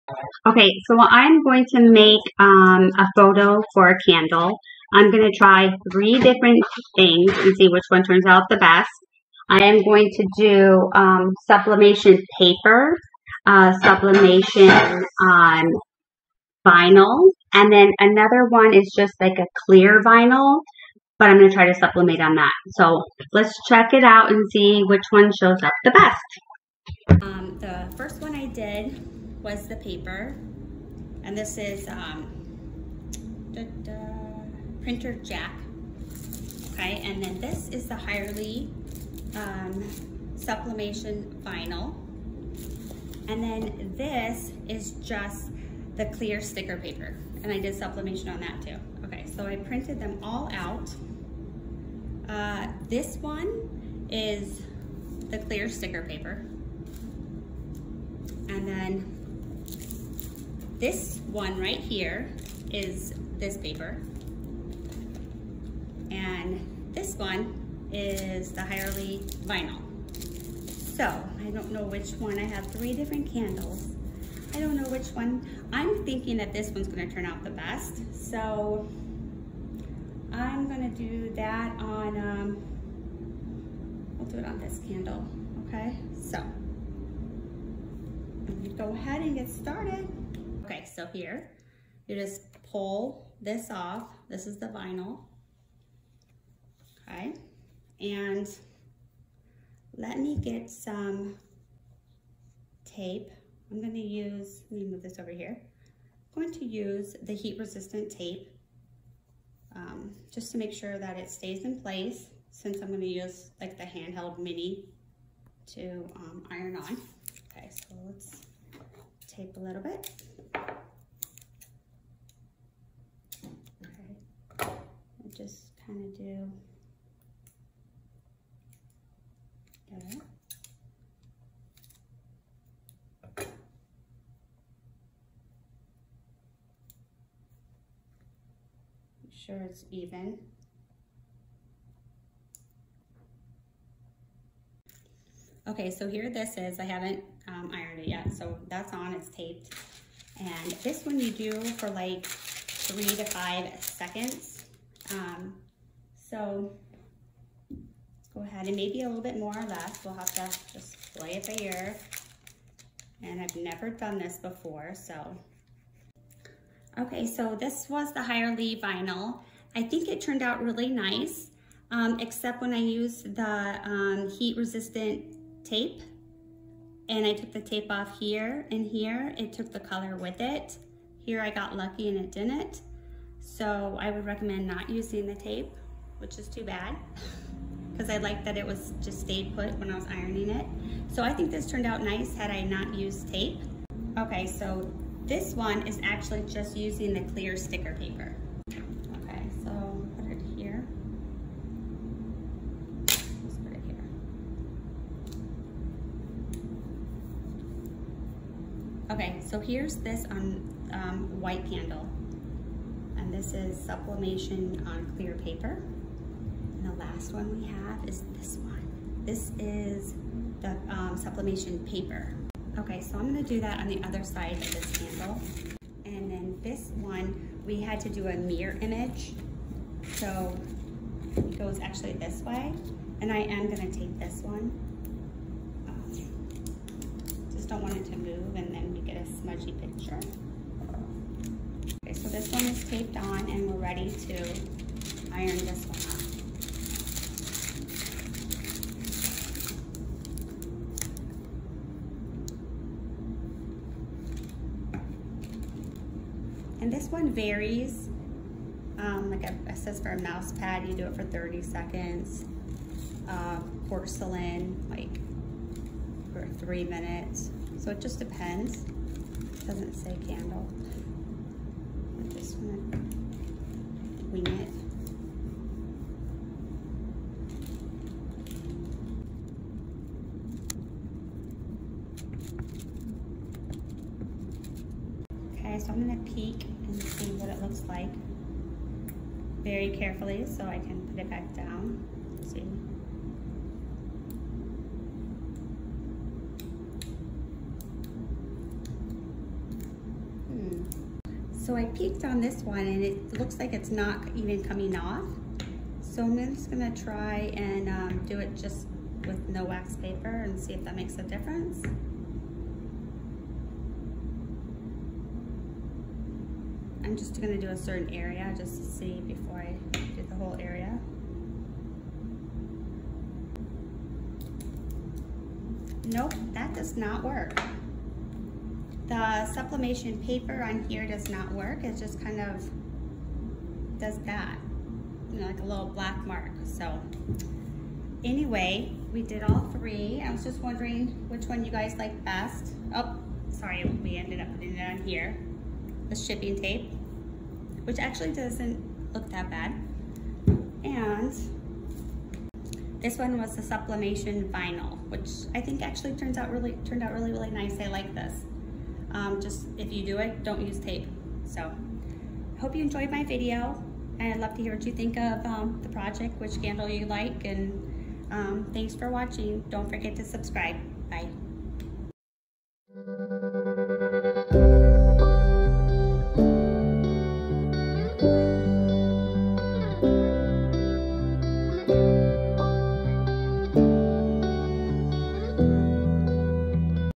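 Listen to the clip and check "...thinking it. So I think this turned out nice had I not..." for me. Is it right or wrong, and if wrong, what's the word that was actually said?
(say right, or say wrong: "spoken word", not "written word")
wrong: "ironing", not "thinking".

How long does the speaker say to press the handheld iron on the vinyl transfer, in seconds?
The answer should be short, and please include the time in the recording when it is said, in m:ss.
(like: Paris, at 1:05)
3 to 5 seconds, at 2:32.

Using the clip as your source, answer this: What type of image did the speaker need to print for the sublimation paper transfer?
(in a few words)
Mirror image.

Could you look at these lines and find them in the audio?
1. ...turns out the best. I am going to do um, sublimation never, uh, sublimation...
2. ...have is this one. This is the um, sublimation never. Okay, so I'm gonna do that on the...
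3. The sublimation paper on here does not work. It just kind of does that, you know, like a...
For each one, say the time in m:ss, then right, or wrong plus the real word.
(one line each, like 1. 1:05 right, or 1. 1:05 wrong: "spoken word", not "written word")
1. 0:08 wrong: "paper", not "never"
2. 3:37 wrong: "paper", not "never"
3. 5:29 right.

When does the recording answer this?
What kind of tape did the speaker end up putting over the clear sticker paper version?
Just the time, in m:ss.
5:46.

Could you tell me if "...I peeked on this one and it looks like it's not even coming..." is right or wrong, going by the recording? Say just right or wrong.
right.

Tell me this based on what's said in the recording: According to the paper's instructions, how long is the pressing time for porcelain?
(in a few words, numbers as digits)
3 minutes.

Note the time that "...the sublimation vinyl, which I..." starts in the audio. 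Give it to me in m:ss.
5:53.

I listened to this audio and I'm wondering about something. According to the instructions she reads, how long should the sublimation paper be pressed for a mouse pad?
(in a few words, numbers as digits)
30 seconds.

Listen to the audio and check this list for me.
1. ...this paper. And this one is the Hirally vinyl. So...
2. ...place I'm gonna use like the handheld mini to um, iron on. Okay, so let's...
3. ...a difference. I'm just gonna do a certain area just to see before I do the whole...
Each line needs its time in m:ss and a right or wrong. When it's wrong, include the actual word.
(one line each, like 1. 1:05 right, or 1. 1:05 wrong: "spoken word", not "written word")
1. 1:03 right
2. 1:52 wrong: "since", not "place"
3. 5:11 right.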